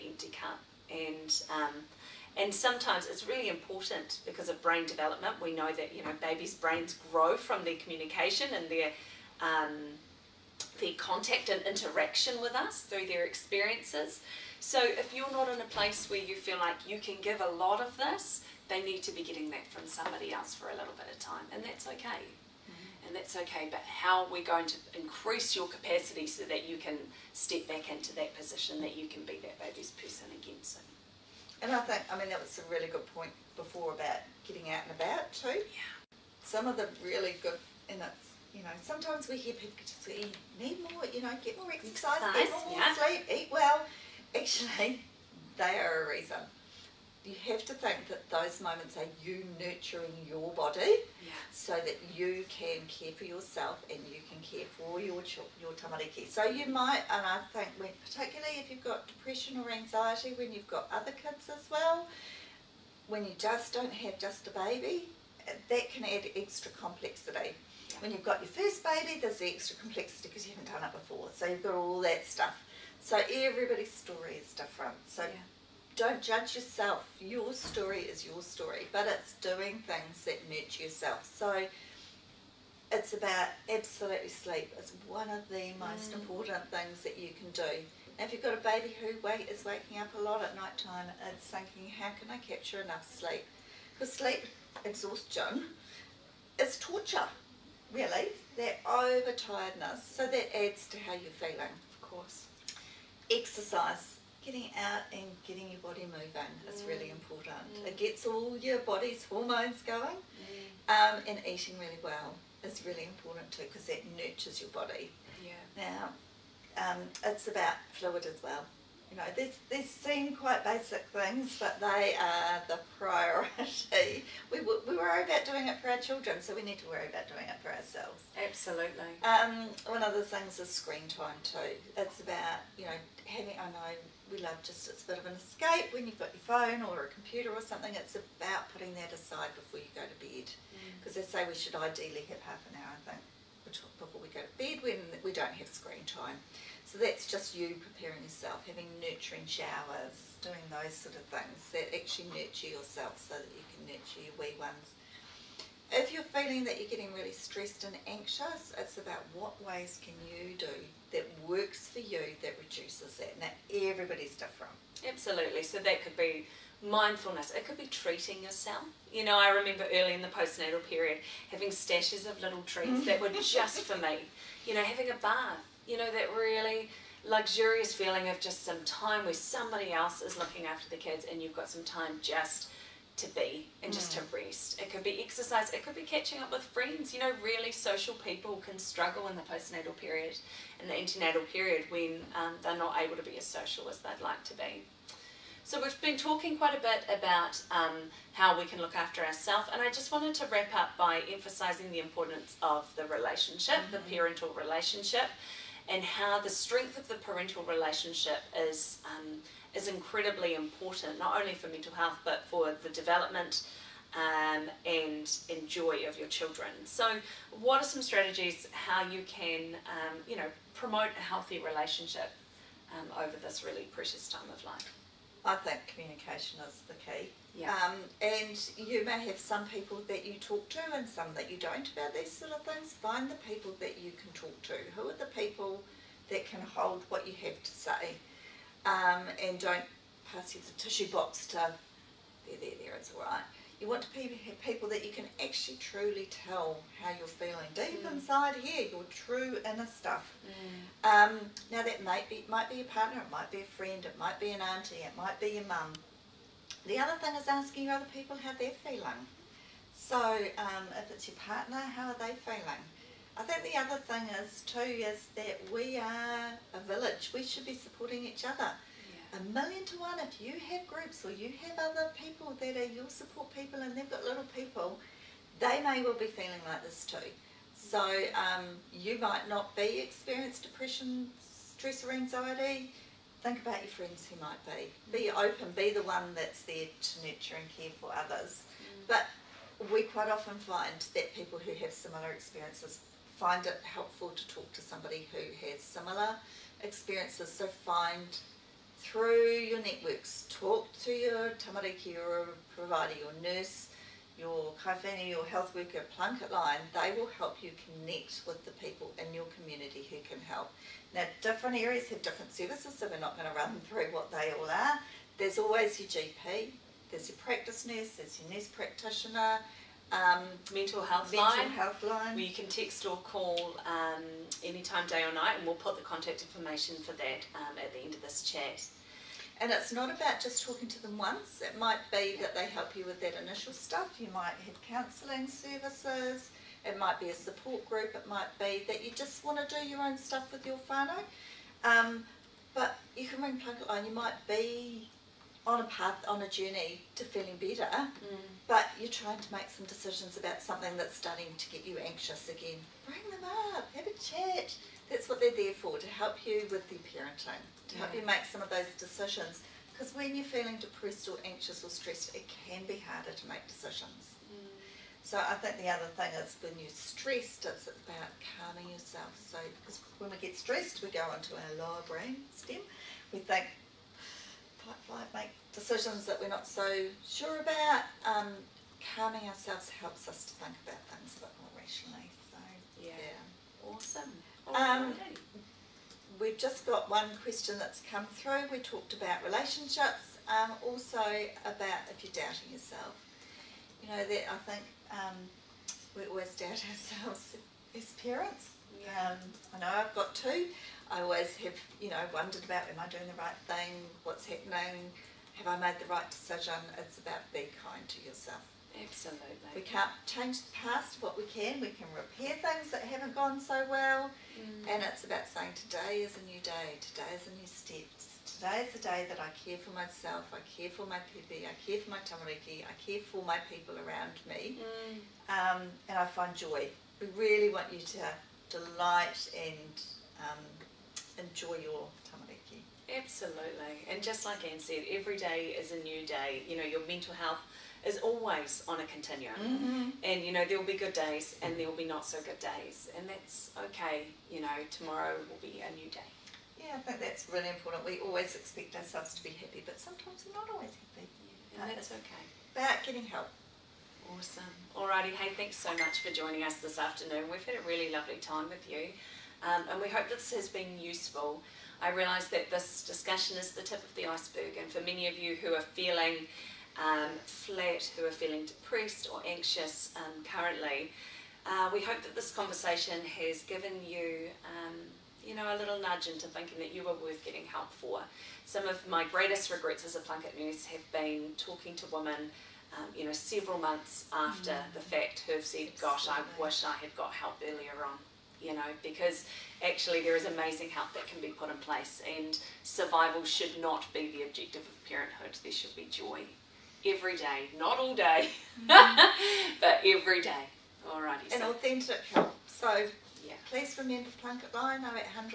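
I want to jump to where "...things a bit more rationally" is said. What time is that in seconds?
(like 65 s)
381 s.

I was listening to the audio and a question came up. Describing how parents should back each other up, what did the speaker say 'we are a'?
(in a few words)
village.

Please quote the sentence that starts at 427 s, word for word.
We really want you to delight and um, enjoy your tamariki.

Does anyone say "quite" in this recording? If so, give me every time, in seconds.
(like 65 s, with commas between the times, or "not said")
120 s, 196 s, 290 s.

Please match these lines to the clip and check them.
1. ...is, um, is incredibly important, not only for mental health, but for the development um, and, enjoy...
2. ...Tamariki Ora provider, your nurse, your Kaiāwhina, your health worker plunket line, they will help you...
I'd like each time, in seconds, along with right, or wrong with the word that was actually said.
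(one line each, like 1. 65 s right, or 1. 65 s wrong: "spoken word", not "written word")
1. 208 s right
2. 301 s right.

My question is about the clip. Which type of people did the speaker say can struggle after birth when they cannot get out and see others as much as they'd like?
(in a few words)
really social people.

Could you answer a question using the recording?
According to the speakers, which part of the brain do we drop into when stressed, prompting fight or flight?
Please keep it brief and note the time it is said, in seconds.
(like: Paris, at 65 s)
lower brain stem, at 371 s.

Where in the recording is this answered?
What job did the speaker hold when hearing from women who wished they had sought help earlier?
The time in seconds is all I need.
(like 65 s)
480 s.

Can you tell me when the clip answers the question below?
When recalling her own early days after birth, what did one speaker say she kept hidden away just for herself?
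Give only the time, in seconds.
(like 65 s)
172 s.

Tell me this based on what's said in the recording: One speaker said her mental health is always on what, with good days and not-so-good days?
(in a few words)
a continuum.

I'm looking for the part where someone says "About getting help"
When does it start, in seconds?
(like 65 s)
452 s.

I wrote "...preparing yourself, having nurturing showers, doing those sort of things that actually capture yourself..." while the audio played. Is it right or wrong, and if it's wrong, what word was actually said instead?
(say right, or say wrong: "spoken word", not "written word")
wrong: "nurture", not "capture".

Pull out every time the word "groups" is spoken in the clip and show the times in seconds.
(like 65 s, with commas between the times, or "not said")
270 s, 337 s.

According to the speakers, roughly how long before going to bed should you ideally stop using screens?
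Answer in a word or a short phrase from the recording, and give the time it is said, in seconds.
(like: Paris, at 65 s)
half an hour, at 142 s.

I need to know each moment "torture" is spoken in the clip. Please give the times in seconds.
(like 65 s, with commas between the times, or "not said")
96 s.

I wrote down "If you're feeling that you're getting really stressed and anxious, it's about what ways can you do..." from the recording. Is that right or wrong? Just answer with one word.
right.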